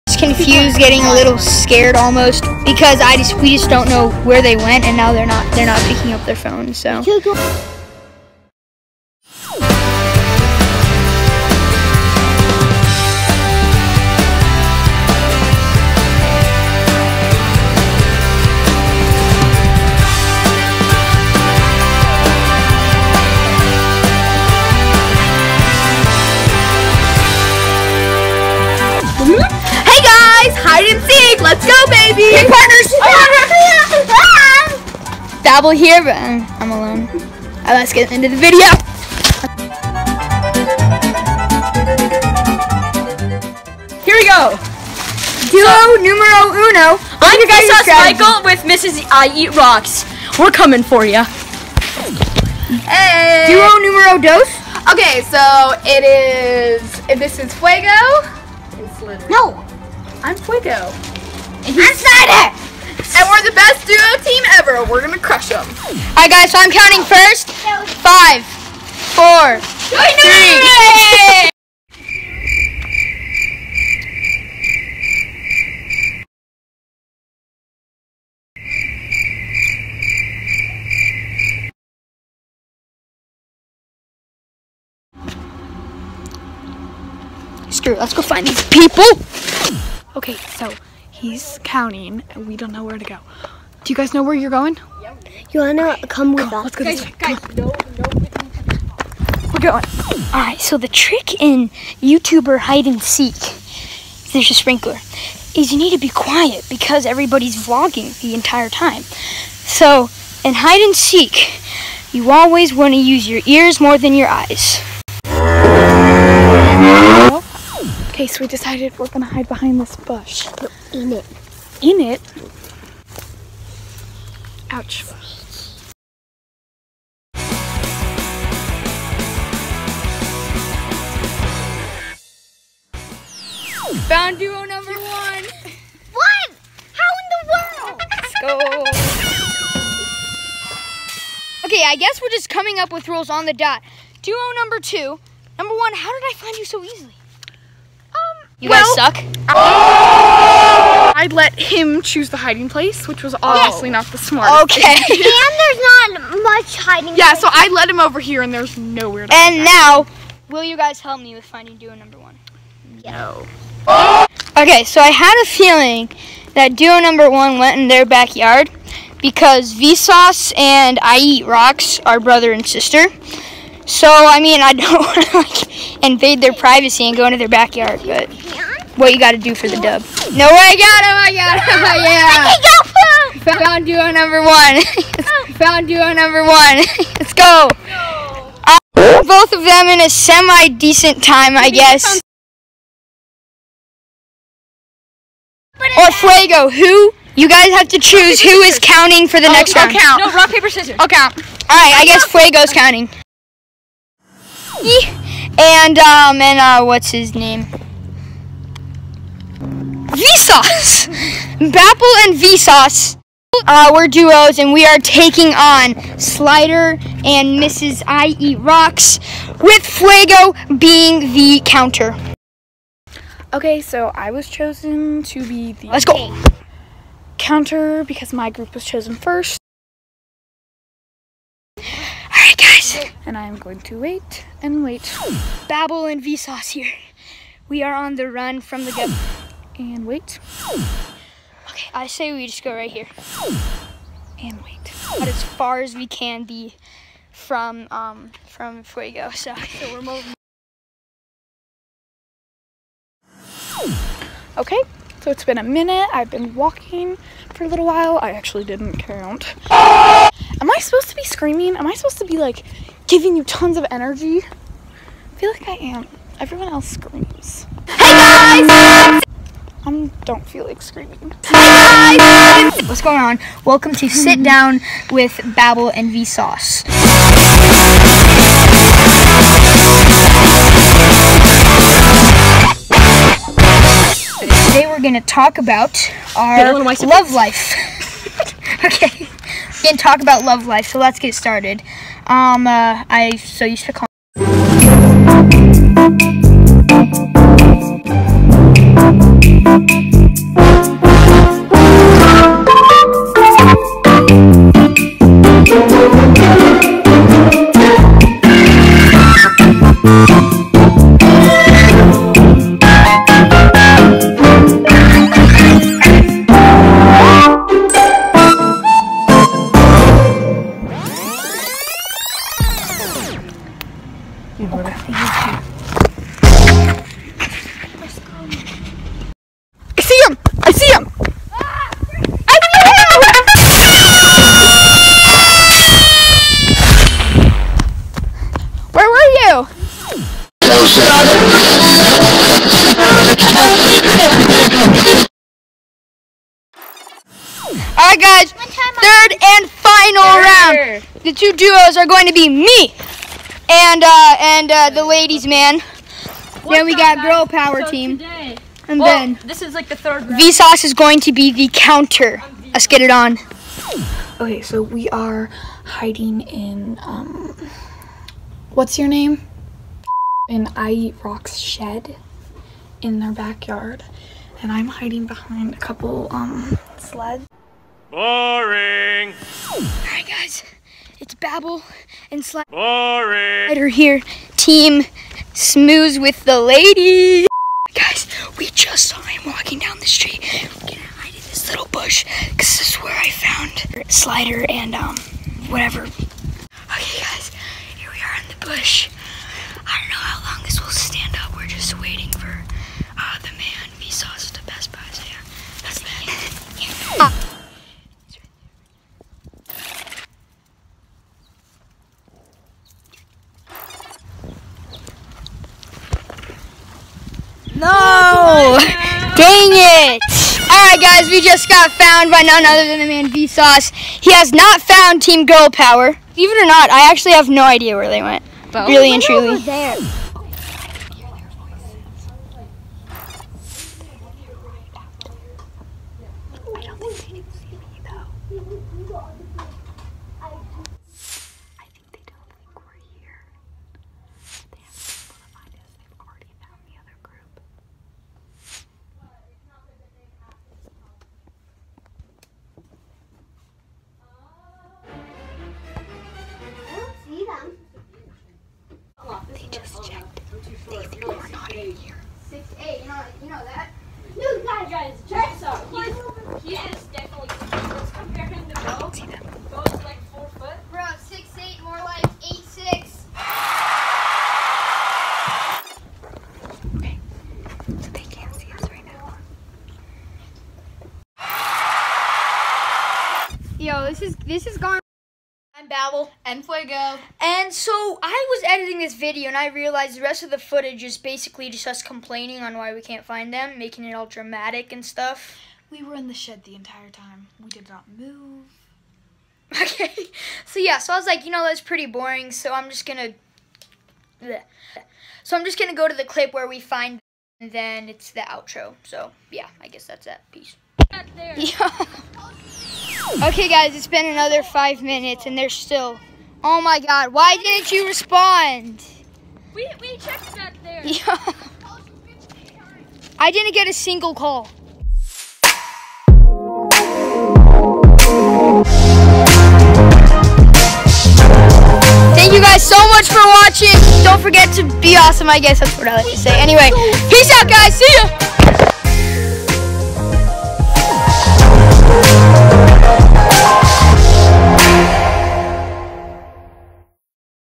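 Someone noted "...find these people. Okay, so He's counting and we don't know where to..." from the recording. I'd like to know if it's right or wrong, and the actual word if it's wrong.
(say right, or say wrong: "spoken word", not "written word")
right.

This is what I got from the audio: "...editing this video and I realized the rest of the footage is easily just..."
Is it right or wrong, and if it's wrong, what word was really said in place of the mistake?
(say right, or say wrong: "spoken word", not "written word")
wrong: "basically", not "easily".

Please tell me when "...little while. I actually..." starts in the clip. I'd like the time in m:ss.
4:17.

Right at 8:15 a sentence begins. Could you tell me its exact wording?
We were in the shed the entire time.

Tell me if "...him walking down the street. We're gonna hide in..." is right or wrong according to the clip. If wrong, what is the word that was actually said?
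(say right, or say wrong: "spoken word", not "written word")
right.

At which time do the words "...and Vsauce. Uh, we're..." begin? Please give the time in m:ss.
3:32.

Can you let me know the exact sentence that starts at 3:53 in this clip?
and I am going to wait and wait.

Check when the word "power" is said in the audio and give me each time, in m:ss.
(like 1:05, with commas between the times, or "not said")
5:57, 7:05.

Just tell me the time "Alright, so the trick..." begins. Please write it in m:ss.
1:40.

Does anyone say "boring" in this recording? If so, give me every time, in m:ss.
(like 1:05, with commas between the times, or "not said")
6:18, 8:22.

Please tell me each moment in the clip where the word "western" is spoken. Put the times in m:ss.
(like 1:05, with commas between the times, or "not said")
not said.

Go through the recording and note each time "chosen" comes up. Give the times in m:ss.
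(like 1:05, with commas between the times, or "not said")
3:44, 3:48.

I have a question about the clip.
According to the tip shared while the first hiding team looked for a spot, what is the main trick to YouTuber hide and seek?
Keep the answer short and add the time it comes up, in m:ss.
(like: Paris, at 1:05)
be quiet, at 1:45.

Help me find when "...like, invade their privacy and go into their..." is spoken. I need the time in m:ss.
2:55.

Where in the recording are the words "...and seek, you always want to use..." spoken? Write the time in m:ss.
1:50.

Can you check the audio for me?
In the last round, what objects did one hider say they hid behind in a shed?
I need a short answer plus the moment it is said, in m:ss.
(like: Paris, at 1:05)
sleds, at 6:16.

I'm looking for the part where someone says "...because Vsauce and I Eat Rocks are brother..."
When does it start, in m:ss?
2:49.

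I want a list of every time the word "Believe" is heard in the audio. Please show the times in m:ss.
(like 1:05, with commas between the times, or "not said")
7:06.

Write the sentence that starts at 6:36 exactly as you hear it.
Okay, guys, here we are in the bush.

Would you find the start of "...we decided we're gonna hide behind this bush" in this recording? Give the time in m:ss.
1:58.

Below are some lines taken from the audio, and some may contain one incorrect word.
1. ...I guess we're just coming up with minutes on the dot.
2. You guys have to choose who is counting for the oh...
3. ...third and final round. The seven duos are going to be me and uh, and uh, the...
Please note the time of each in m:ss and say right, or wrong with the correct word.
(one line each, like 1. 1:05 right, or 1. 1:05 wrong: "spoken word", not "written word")
1. 2:21 wrong: "rules", not "minutes"
2. 3:17 right
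3. 5:48 wrong: "two", not "seven".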